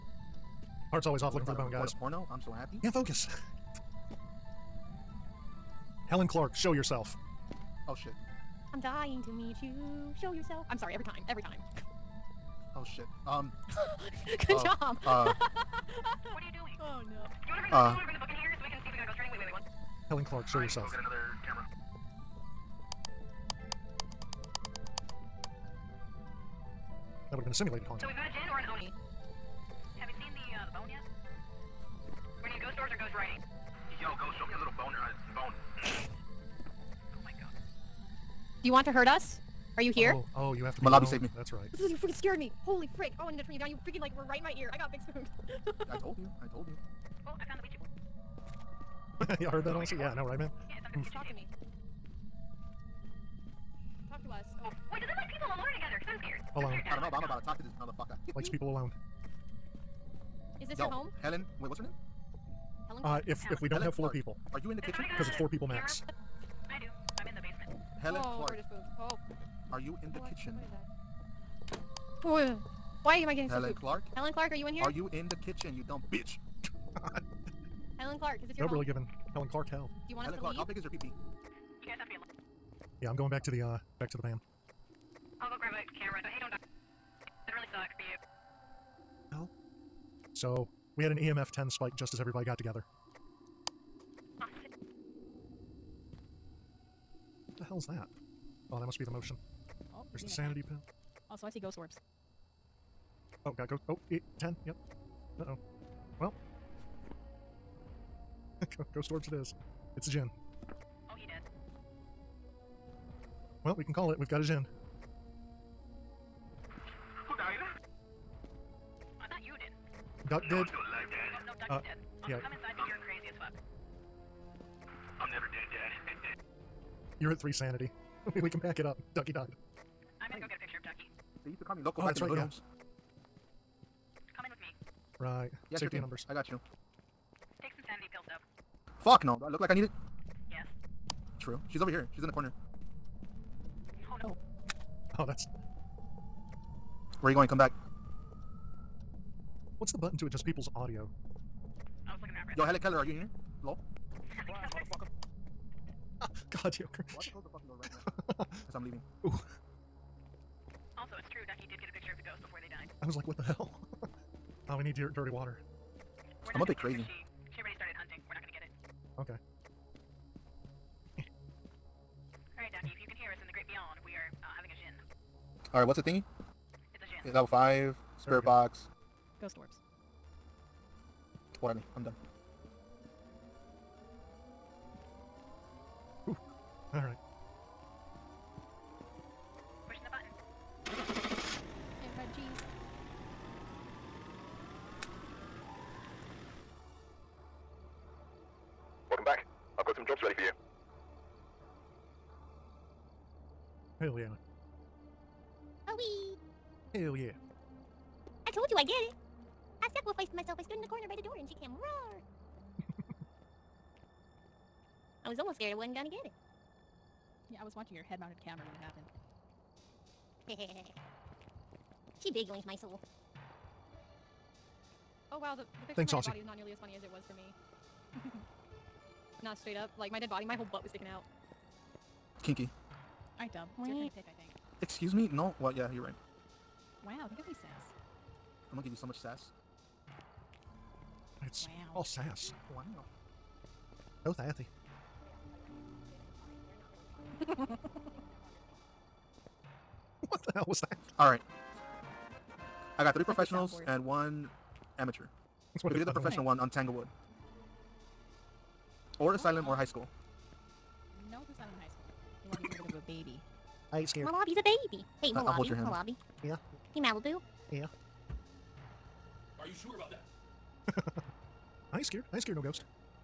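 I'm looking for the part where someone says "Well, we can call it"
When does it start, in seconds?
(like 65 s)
113 s.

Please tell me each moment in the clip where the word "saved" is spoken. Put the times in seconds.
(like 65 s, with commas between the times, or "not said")
41 s.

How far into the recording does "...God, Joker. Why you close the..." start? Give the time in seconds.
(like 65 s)
156 s.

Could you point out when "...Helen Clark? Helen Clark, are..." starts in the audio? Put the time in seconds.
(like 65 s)
73 s.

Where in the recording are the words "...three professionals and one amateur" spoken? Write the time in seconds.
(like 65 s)
253 s.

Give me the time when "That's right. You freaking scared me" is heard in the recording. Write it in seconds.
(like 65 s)
41 s.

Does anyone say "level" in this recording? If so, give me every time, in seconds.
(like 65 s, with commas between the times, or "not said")
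177 s.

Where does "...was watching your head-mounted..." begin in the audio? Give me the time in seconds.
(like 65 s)
217 s.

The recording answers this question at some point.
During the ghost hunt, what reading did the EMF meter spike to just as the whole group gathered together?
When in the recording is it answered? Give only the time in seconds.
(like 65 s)
91 s.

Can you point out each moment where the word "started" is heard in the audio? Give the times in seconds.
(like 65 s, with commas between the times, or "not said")
167 s.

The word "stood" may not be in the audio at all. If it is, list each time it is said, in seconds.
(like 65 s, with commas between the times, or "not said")
210 s.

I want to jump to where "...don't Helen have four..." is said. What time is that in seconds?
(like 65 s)
63 s.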